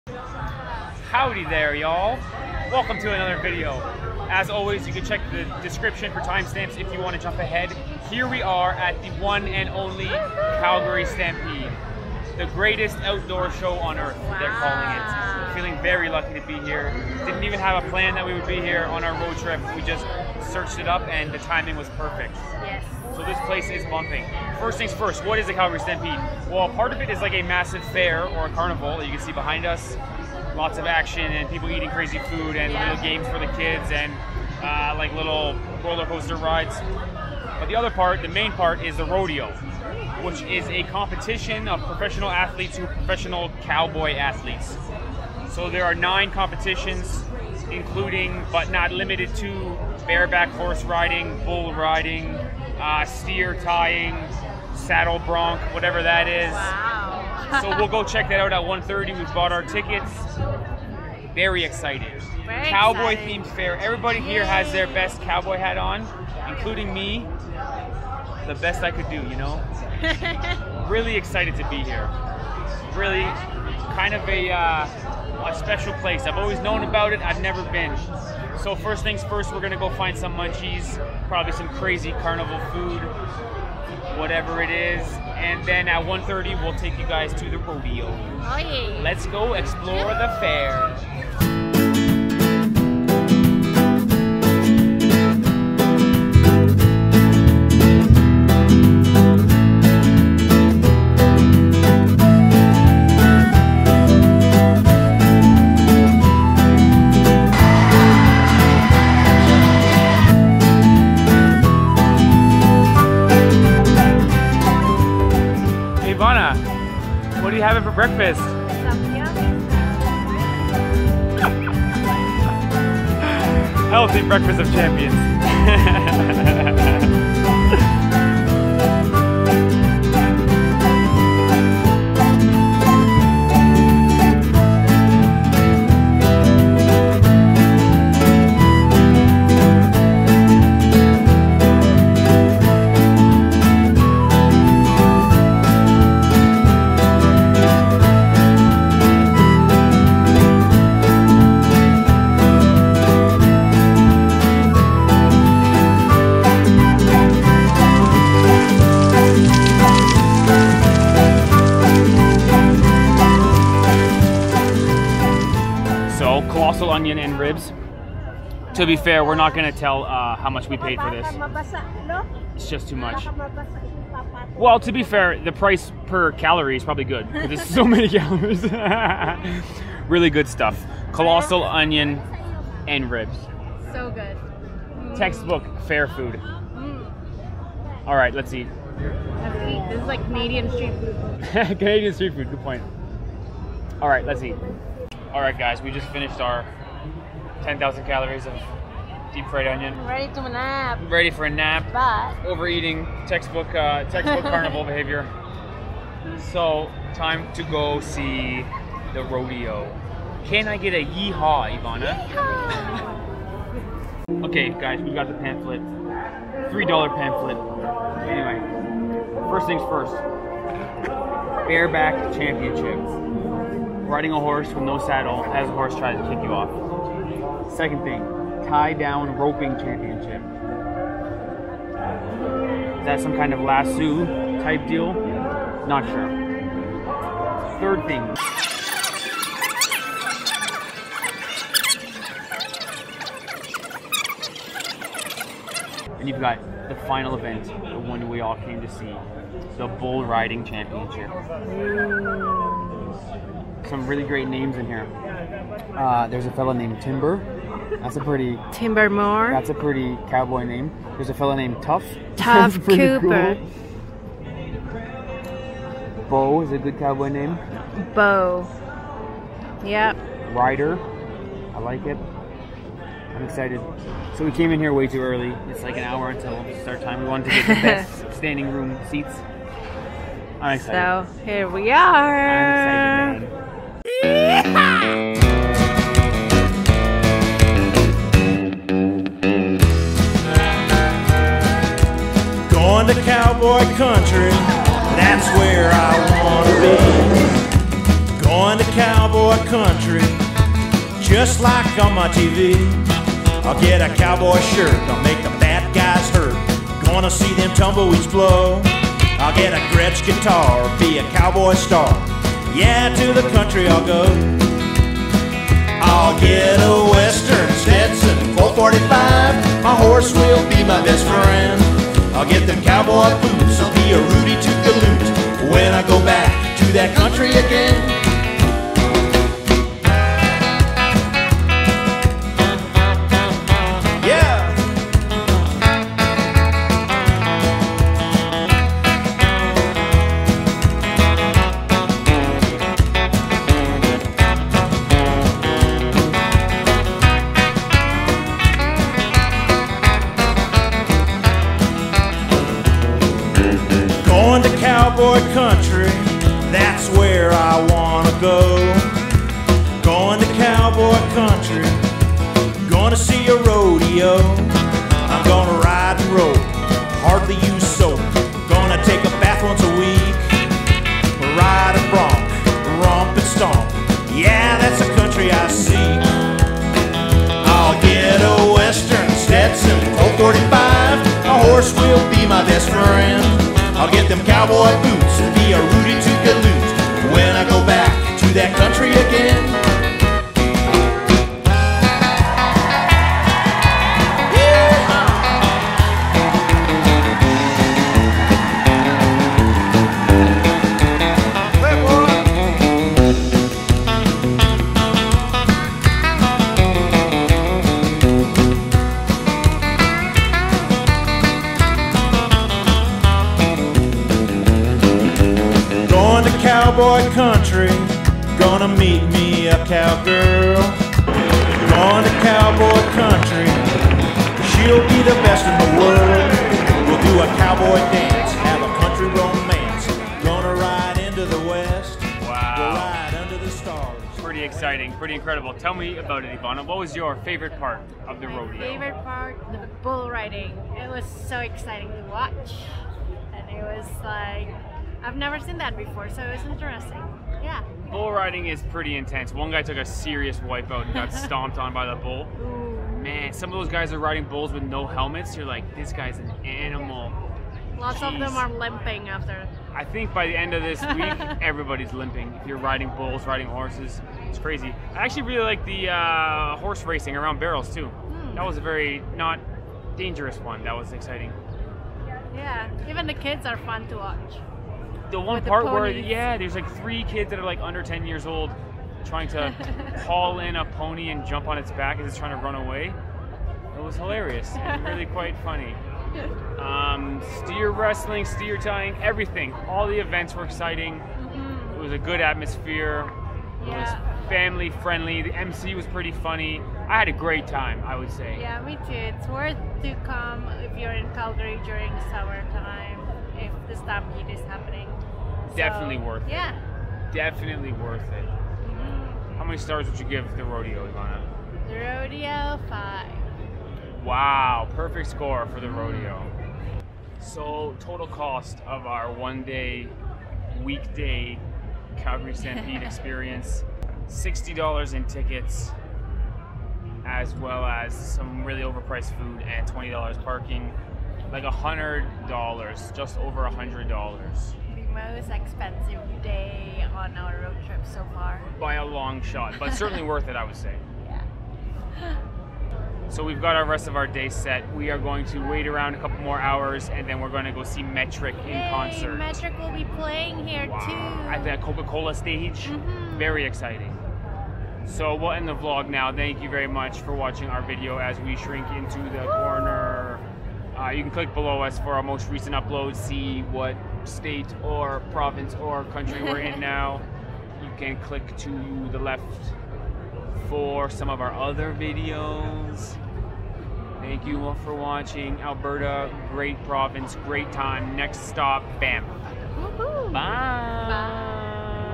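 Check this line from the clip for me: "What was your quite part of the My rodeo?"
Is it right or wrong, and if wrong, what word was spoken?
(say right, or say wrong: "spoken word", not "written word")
wrong: "favorite", not "quite".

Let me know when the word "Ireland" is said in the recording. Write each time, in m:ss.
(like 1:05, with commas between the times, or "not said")
not said.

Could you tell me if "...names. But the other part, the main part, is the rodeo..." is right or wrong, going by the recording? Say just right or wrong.
wrong.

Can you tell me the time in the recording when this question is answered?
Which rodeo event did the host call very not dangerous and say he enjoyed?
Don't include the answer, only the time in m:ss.
7:46.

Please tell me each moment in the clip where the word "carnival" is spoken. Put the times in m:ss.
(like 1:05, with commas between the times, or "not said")
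0:28, 1:22, 3:24.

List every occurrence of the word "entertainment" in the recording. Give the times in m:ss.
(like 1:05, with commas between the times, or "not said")
not said.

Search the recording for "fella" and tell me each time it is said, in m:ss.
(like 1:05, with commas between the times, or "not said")
4:16, 4:21.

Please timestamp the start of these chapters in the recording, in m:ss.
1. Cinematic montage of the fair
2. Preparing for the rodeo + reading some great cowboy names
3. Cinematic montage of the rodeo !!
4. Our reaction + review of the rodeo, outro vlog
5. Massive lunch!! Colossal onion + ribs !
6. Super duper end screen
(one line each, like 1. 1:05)
1. 1:31
2. 3:15
3. 4:44
4. 7:12
5. 2:44
6. 9:18.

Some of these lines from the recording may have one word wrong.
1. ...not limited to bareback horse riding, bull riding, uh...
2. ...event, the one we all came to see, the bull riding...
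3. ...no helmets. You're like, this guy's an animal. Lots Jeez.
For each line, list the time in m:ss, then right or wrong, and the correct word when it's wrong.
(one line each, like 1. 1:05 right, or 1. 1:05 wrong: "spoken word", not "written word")
1. 0:48 right
2. 4:07 right
3. 7:34 right.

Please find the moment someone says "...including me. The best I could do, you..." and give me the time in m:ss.
1:06.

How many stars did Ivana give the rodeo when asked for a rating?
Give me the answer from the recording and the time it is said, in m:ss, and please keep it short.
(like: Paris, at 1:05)
5, at 8:32.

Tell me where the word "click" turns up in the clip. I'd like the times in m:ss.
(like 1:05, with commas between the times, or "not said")
9:21, 9:28.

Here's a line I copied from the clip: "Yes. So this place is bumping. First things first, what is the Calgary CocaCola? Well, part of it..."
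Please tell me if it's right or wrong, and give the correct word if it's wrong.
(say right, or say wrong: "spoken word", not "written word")
wrong: "Stampede", not "CocaCola".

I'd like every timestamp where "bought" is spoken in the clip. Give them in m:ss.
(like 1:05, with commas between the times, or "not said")
0:59.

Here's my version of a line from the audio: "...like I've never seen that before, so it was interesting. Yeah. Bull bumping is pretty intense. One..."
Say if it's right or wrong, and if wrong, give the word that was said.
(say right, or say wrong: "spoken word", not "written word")
wrong: "riding", not "bumping".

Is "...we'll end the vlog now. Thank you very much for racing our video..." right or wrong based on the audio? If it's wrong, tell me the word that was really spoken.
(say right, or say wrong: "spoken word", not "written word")
wrong: "watching", not "racing".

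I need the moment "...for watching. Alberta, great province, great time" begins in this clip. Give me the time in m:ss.
9:34.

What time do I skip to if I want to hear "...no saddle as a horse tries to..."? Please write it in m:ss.
3:44.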